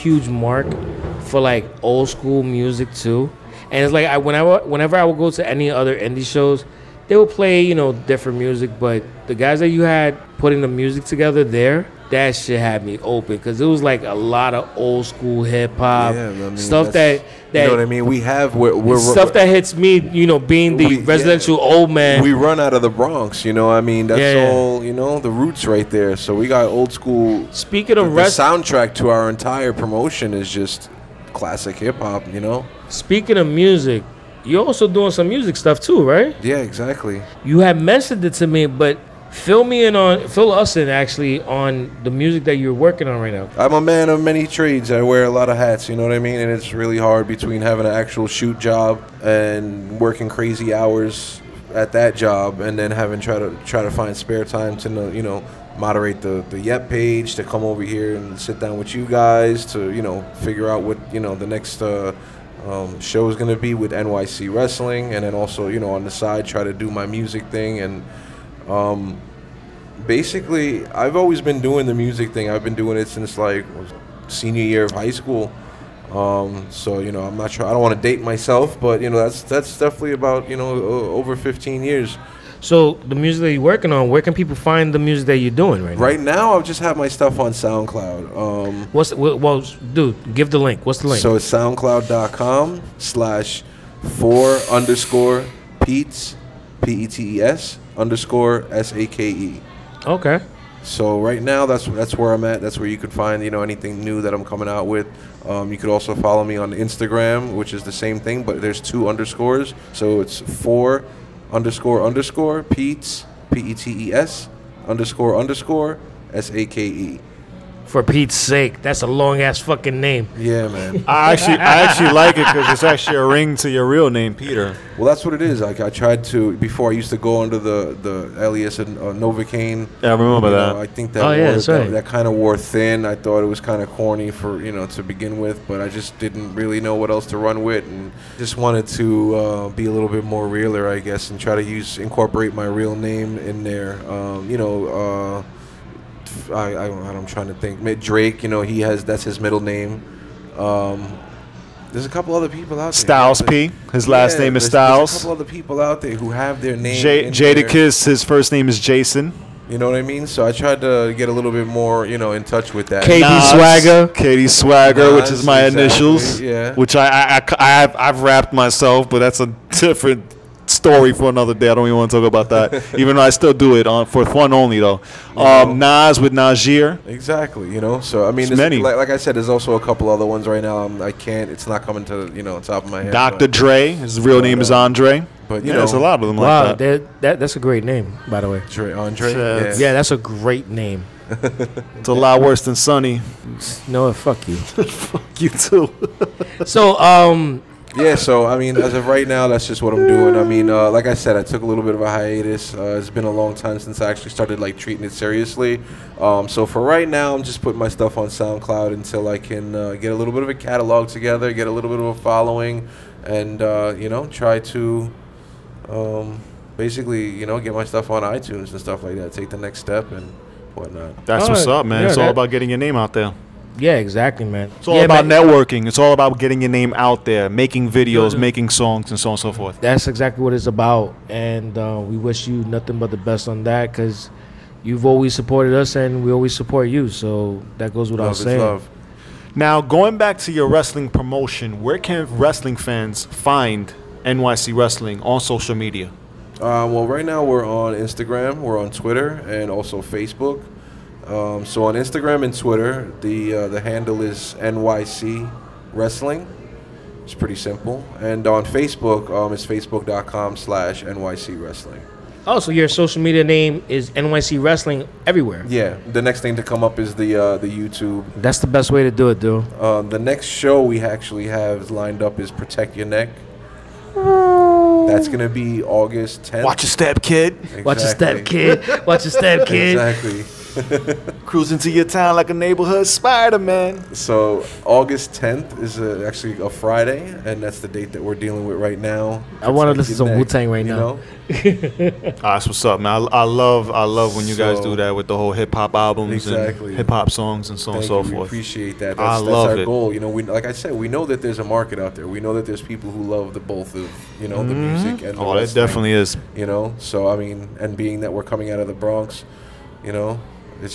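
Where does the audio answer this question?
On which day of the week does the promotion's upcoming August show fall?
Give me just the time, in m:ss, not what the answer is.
4:46.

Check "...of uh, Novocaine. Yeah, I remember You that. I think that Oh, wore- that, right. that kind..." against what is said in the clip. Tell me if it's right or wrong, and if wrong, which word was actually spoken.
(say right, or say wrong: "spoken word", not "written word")
right.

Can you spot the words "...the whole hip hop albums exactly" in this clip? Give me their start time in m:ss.
4:55.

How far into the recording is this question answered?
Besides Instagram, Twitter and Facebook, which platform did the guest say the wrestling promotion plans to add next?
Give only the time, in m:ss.
4:27.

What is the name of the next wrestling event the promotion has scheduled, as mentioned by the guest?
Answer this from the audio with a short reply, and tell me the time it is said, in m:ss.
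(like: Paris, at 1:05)
Protect Your Neck, at 4:32.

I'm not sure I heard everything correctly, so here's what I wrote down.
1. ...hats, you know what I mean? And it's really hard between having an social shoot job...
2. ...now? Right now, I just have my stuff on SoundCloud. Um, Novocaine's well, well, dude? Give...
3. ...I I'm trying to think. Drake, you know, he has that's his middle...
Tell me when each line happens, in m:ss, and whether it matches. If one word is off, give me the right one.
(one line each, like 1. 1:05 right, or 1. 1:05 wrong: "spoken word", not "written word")
1. 0:45 wrong: "actual", not "social"
2. 1:25 wrong: "What", not "Novocaine"
3. 2:26 right.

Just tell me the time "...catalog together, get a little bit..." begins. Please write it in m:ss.
3:30.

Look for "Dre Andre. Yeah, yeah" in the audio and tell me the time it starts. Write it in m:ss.
3:08.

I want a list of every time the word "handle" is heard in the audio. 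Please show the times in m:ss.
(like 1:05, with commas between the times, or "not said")
4:13.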